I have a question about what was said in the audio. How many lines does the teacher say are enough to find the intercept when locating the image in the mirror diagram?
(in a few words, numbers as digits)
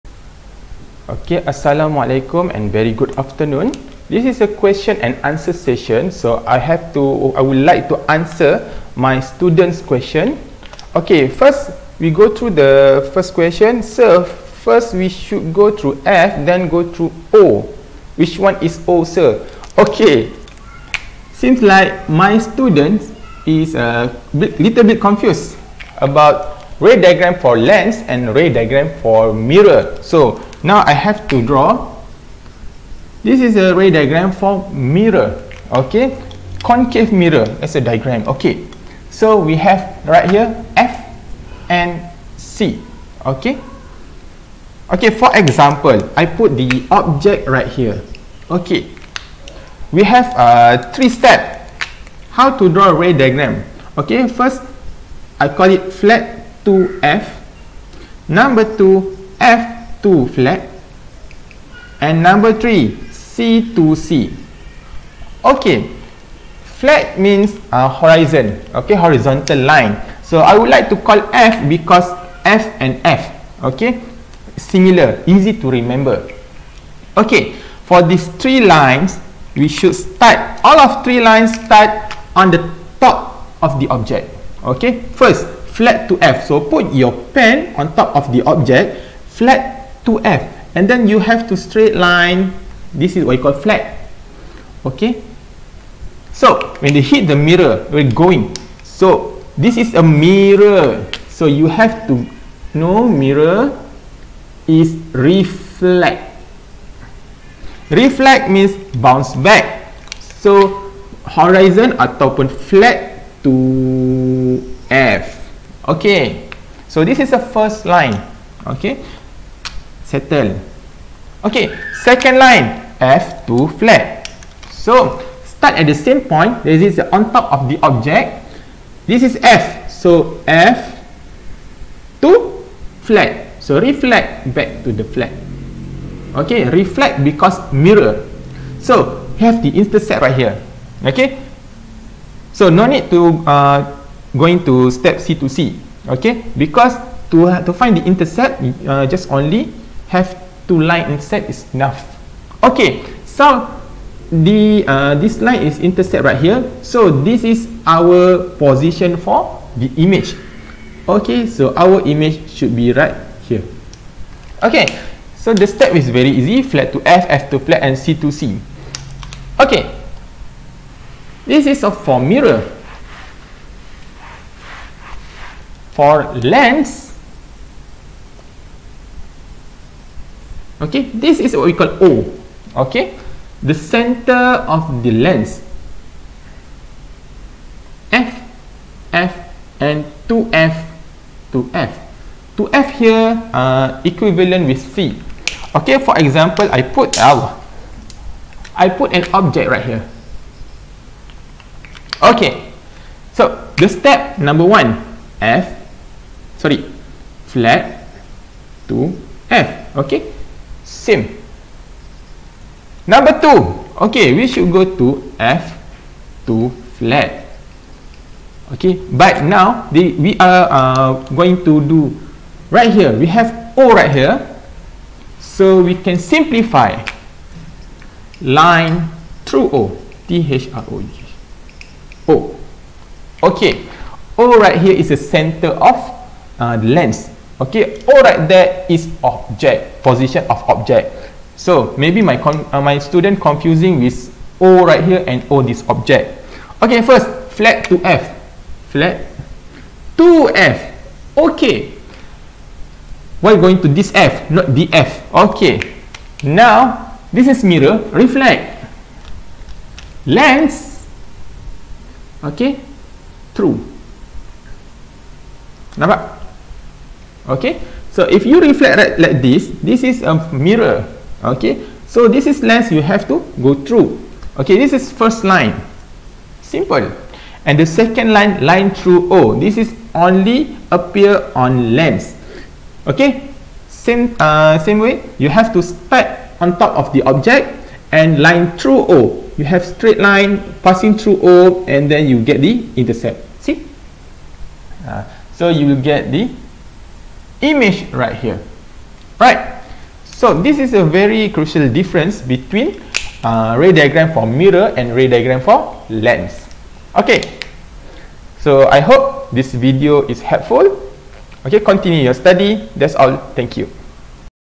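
2.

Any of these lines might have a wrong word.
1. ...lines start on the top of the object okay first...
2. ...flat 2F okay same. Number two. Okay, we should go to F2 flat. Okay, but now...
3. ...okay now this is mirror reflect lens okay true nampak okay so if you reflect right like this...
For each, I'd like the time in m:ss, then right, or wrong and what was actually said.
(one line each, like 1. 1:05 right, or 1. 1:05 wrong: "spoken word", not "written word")
1. 1:21 right
2. 3:27 right
3. 4:15 right.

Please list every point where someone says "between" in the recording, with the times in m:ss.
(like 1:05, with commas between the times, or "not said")
5:02.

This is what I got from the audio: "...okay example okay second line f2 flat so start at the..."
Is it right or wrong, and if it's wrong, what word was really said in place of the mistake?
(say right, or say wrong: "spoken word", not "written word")
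wrong: "settle", not "example".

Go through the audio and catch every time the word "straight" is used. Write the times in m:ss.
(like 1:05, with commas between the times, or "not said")
1:31, 4:49.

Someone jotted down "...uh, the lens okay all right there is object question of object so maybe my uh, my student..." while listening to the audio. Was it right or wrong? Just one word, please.
wrong.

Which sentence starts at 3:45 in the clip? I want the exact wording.
So we can simplify line through O.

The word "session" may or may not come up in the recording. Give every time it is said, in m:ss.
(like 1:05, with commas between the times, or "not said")
0:05.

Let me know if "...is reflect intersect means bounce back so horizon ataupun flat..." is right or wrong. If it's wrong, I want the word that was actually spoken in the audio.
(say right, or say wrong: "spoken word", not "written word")
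wrong: "reflect", not "intersect".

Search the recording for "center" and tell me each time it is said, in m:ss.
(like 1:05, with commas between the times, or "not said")
3:03, 3:55.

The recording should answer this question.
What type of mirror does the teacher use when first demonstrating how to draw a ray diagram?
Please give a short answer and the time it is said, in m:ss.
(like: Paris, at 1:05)
Concave mirror, at 0:36.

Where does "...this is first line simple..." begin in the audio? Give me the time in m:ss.
4:34.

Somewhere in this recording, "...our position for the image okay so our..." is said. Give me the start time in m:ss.
2:37.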